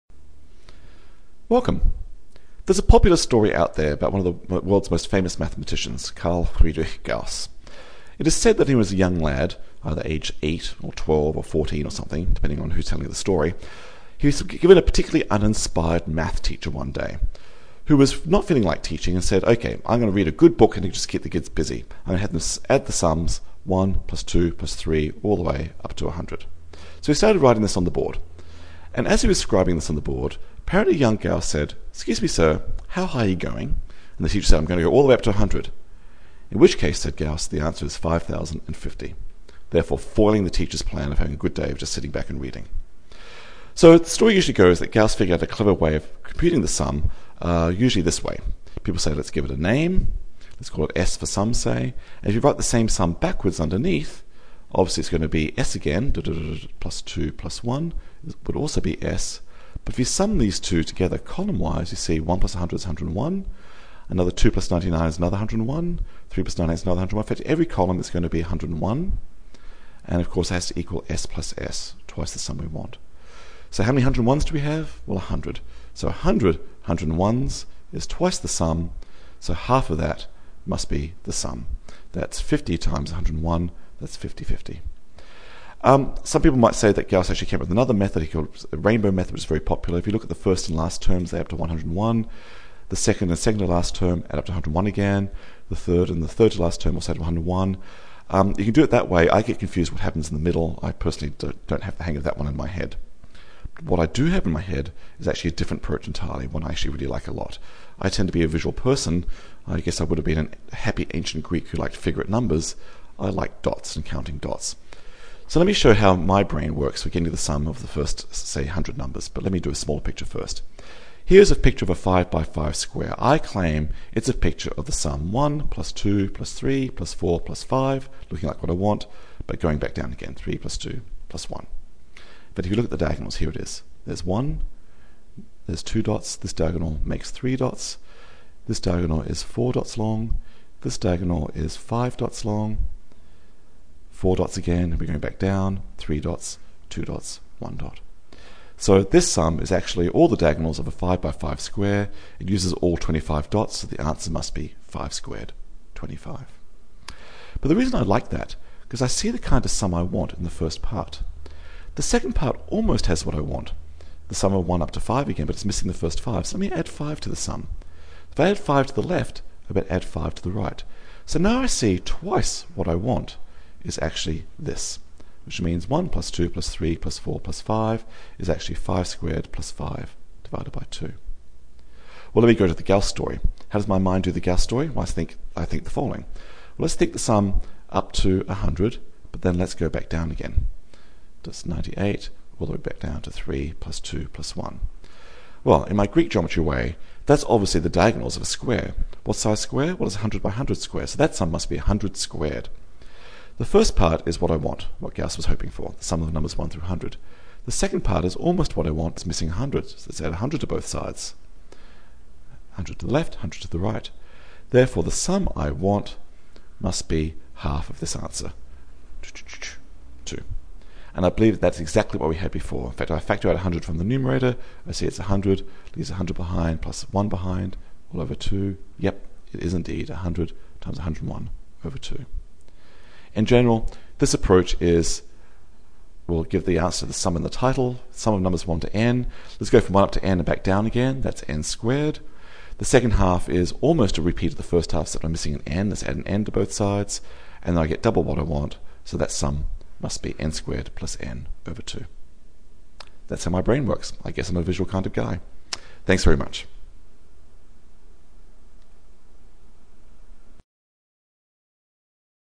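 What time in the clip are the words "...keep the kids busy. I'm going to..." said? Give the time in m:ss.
0:21.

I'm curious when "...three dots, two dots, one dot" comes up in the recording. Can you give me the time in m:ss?
2:25.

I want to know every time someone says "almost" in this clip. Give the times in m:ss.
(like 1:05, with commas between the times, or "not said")
2:42, 3:28, 4:03.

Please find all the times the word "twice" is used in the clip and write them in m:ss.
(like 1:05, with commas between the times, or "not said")
1:12, 1:18, 2:51.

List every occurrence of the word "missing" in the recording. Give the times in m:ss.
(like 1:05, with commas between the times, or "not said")
2:45, 3:29, 4:05.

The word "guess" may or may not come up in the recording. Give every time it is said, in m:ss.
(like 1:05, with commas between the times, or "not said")
1:49, 4:14.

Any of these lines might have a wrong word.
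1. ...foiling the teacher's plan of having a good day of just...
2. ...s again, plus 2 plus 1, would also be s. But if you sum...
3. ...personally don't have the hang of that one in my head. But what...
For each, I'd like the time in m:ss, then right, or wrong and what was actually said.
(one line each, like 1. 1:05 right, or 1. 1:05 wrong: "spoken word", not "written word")
1. 0:39 right
2. 0:55 right
3. 1:40 right.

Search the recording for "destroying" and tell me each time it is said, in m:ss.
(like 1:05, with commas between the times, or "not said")
not said.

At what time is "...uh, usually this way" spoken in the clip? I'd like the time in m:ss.
0:47.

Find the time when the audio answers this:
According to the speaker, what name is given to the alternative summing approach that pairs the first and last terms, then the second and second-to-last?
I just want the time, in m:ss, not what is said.
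1:28.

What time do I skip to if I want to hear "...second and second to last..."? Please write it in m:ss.
1:32.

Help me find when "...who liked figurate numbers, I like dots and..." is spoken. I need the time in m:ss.
1:51.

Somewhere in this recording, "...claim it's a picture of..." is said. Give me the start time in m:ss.
2:03.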